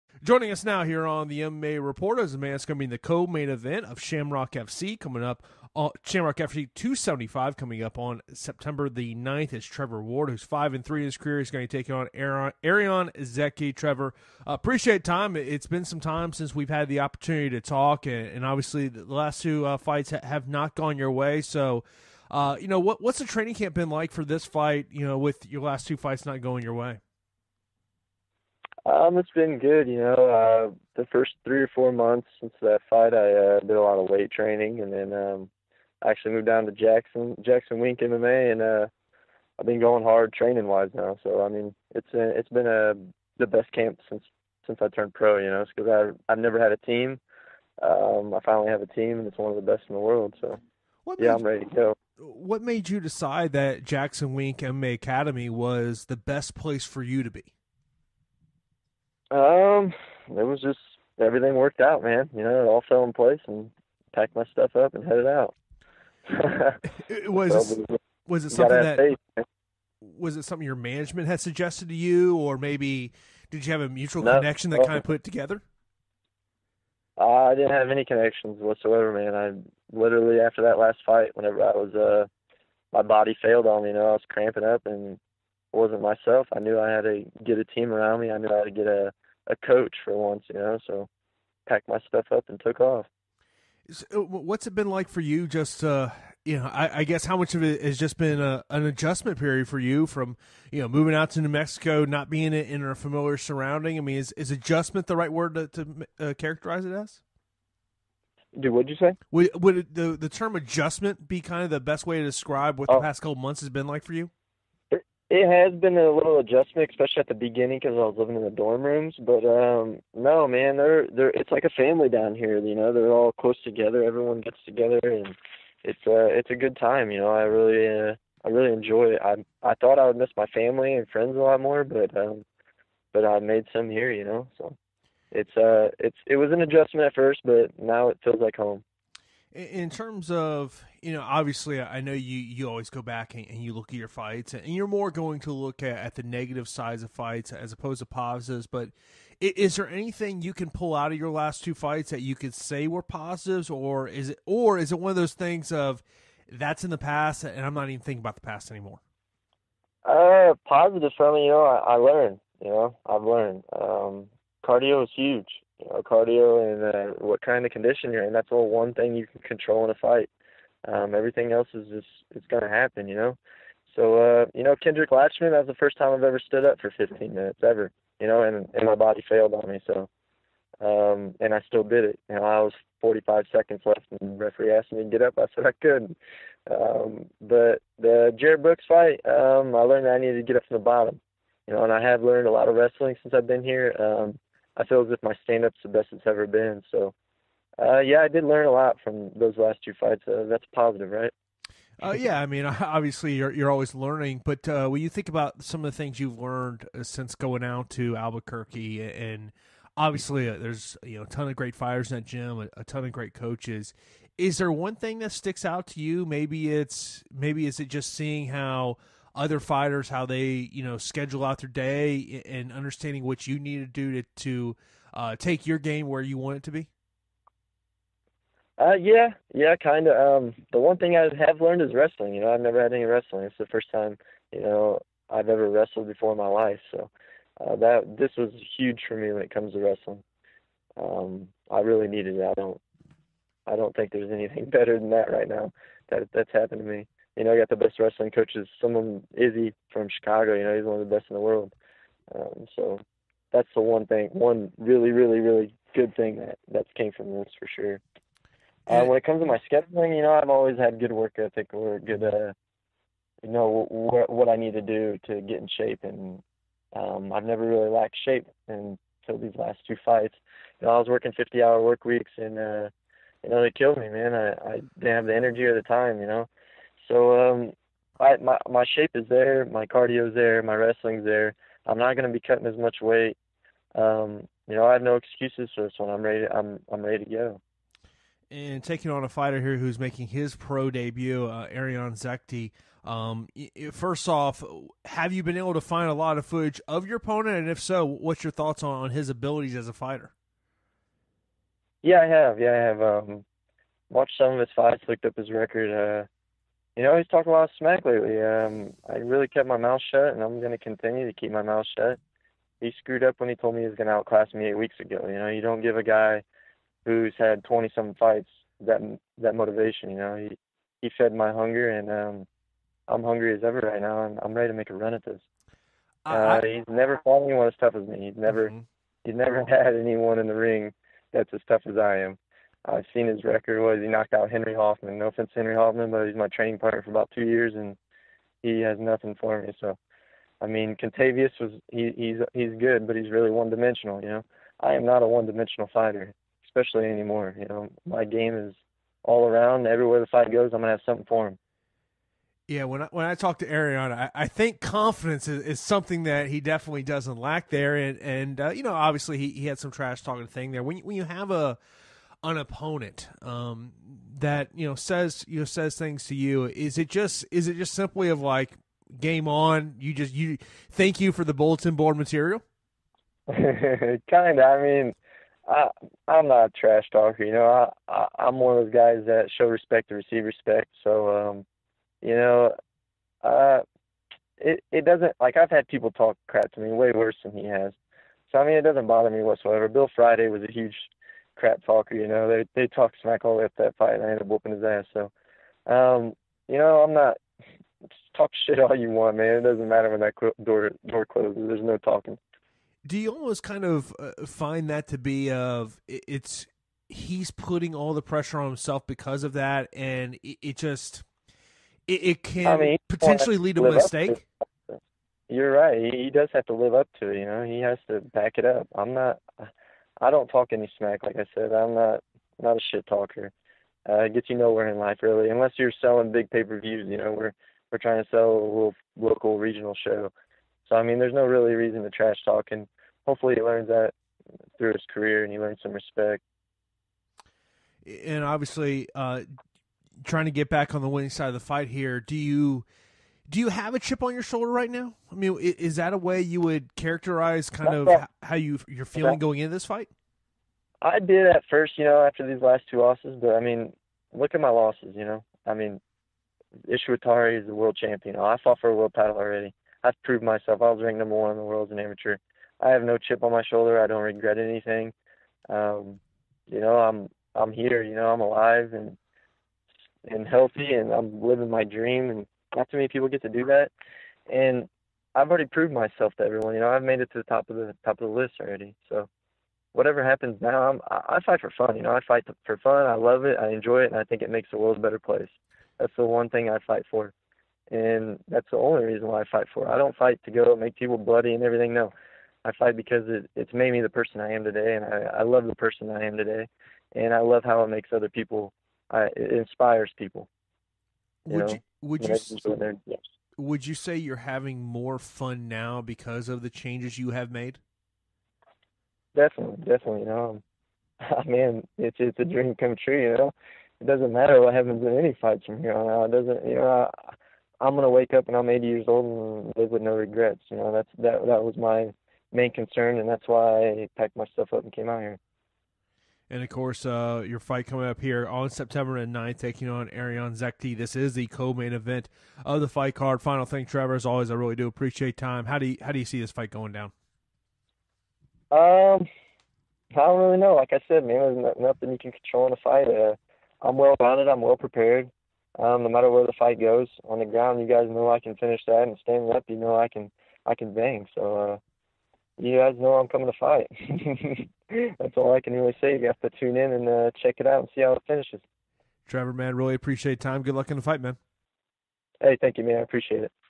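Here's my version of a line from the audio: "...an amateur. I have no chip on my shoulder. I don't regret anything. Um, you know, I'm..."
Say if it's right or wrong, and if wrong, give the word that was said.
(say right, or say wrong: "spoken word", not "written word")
right.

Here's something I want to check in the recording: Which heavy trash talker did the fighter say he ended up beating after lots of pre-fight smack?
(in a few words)
Bill Friday.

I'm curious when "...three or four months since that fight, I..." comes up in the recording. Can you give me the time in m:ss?
0:31.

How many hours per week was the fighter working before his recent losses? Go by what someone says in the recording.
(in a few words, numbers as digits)
50.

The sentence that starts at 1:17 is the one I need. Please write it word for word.
Uh, I didn't have any connections whatsoever, man.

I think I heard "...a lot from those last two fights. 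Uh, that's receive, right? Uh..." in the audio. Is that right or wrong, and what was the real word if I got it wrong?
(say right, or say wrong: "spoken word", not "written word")
wrong: "positive", not "receive".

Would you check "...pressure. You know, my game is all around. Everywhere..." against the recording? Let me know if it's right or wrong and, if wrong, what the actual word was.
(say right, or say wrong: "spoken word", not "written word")
wrong: "anymore", not "pressure".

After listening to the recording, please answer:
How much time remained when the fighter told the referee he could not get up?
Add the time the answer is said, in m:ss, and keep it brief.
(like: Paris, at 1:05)
45 seconds, at 3:02.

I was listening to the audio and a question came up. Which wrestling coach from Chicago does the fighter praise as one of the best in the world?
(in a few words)
Izzy.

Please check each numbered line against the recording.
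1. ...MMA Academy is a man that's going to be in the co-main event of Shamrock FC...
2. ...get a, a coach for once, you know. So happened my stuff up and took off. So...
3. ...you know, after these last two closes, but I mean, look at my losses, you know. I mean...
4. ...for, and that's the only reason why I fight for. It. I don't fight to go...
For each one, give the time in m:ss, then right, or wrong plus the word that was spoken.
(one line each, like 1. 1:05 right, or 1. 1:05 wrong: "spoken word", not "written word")
1. 0:01 wrong: "Report", not "Academy"
2. 1:28 wrong: "packed", not "happened"
3. 7:31 wrong: "losses", not "closes"
4. 8:07 right.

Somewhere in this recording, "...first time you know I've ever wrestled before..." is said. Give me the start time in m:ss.
3:53.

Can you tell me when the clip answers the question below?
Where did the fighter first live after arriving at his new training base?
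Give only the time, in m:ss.
1:58.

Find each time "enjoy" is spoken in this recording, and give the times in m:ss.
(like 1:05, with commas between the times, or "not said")
2:08, 8:03.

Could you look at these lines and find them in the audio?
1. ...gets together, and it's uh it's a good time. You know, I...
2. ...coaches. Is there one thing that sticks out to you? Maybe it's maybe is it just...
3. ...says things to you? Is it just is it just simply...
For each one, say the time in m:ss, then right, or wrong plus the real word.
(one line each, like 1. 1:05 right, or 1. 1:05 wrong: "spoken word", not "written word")
1. 2:04 right
2. 3:33 right
3. 6:05 right.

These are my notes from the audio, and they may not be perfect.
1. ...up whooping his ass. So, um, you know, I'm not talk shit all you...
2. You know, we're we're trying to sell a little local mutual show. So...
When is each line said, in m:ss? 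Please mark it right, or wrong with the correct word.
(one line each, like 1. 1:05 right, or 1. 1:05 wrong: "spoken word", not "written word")
1. 6:34 right
2. 7:07 wrong: "regional", not "mutual".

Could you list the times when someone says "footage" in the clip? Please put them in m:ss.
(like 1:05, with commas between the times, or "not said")
4:56.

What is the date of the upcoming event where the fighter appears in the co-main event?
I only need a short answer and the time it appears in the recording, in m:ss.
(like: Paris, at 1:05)
September 9, at 0:08.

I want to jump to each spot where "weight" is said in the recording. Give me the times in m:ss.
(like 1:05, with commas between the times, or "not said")
0:34, 4:43.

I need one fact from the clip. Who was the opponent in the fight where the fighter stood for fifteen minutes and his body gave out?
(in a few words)
Kendrick Latchman.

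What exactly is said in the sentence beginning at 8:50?
This is the co-main event of the fight card.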